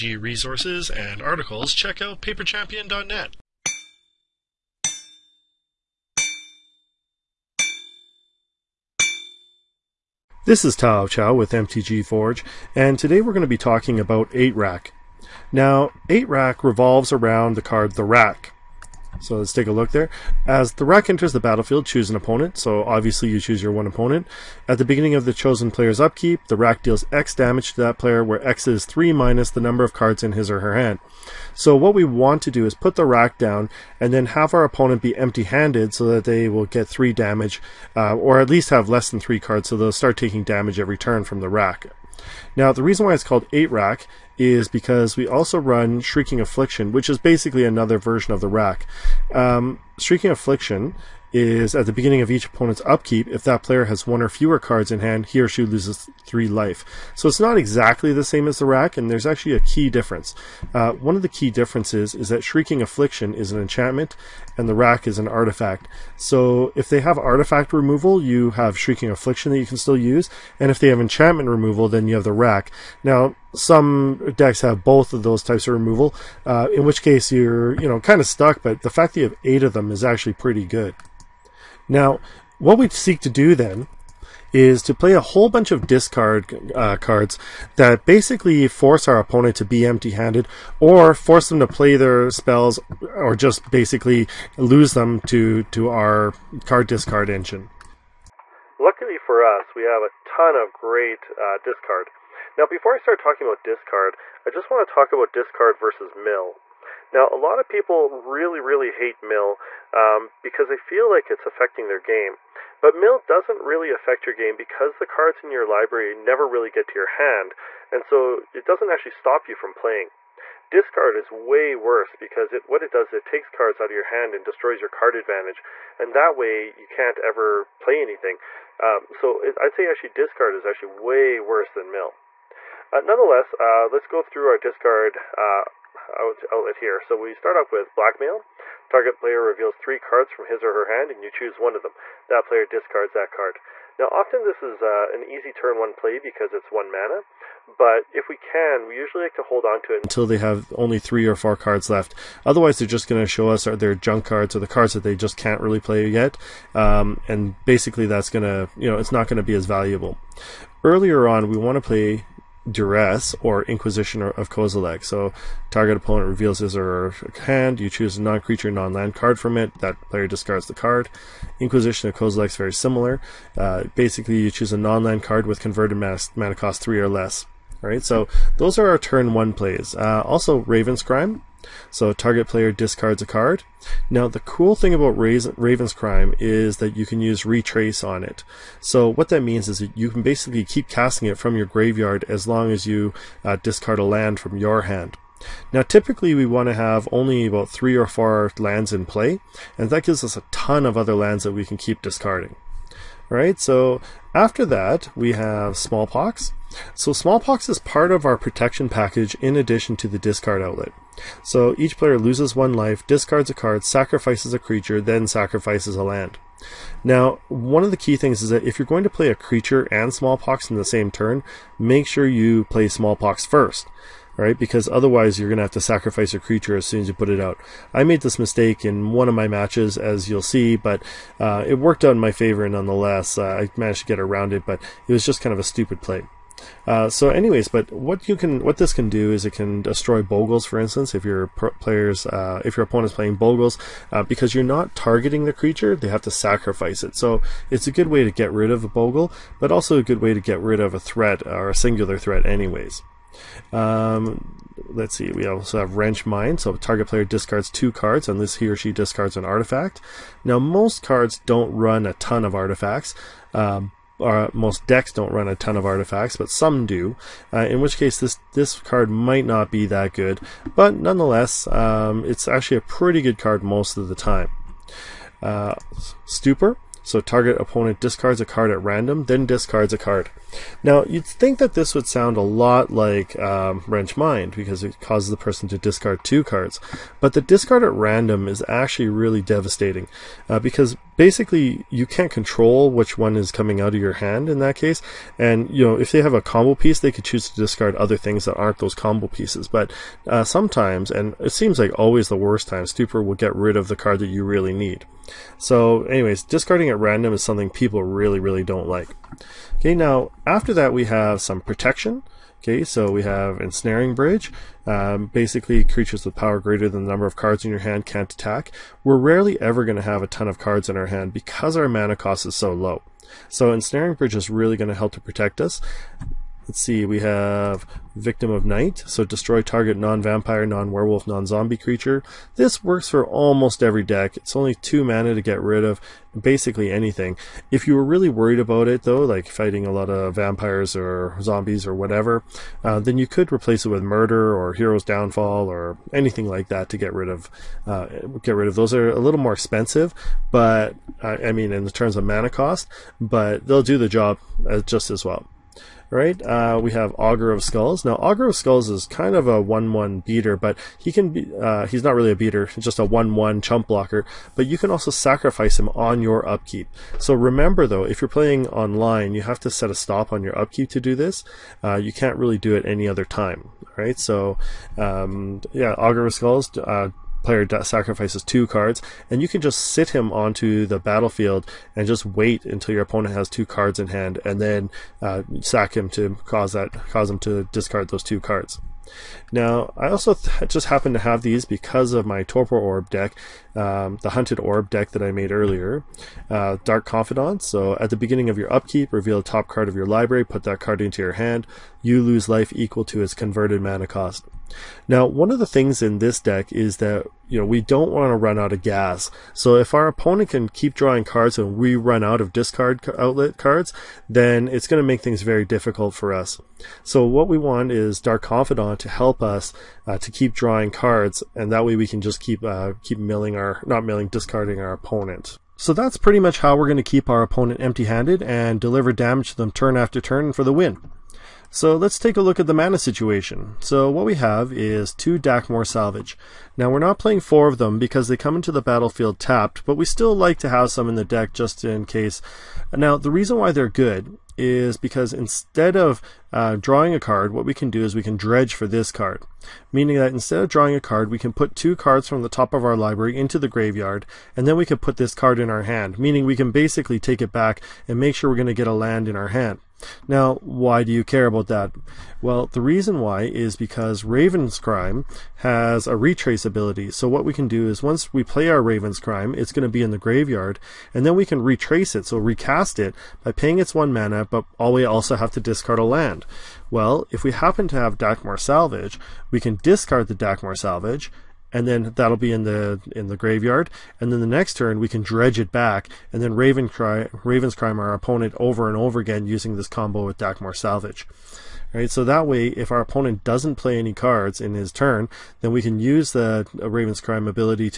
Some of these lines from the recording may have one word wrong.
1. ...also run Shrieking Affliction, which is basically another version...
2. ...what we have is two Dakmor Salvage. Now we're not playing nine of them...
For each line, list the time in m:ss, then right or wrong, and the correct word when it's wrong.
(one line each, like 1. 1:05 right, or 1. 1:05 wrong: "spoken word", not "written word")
1. 0:45 right
2. 7:14 wrong: "four", not "nine".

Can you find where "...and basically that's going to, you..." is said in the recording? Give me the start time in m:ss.
2:37.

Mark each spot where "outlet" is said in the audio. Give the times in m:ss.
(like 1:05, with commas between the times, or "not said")
2:16, 3:30, 6:53.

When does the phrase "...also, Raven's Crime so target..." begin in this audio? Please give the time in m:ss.
3:00.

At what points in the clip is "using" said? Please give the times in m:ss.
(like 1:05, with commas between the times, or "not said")
8:09.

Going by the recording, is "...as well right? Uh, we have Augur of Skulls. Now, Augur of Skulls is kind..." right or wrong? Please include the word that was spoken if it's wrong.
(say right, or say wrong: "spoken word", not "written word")
right.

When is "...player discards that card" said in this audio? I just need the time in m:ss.
2:22.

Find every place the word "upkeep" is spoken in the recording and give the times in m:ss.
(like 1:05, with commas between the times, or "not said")
0:25, 0:52, 6:06, 6:10, 6:38.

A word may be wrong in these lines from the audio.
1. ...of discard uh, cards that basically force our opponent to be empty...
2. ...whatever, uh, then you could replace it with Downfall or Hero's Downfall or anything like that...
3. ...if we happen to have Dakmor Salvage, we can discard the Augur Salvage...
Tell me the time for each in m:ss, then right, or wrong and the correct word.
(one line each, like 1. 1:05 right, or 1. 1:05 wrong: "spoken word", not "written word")
1. 1:25 right
2. 5:41 wrong: "Murder", not "Downfall"
3. 7:57 wrong: "Dakmor", not "Augur".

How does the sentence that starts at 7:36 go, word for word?
Meaning we can basically take it back and make sure we're going to get a land in our hand.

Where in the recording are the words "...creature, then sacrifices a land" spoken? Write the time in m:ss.
3:34.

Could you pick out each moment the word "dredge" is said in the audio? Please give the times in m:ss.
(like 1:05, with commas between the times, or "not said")
7:28, 8:05.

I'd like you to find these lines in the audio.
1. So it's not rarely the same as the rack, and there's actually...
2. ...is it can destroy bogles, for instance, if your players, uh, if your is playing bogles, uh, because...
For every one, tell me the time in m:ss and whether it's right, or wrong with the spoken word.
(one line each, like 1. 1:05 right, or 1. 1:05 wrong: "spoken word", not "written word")
1. 0:57 wrong: "exactly", not "rarely"
2. 3:59 right.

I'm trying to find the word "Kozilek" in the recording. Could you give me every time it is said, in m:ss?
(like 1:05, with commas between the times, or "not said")
2:44, 2:52.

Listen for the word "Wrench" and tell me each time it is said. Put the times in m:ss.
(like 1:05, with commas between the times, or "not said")
4:15, 4:43.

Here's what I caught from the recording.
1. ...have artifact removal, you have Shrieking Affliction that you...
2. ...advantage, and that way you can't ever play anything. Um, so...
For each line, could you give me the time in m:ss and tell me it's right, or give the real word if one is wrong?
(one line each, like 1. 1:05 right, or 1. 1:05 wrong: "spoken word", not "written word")
1. 1:06 right
2. 2:05 right.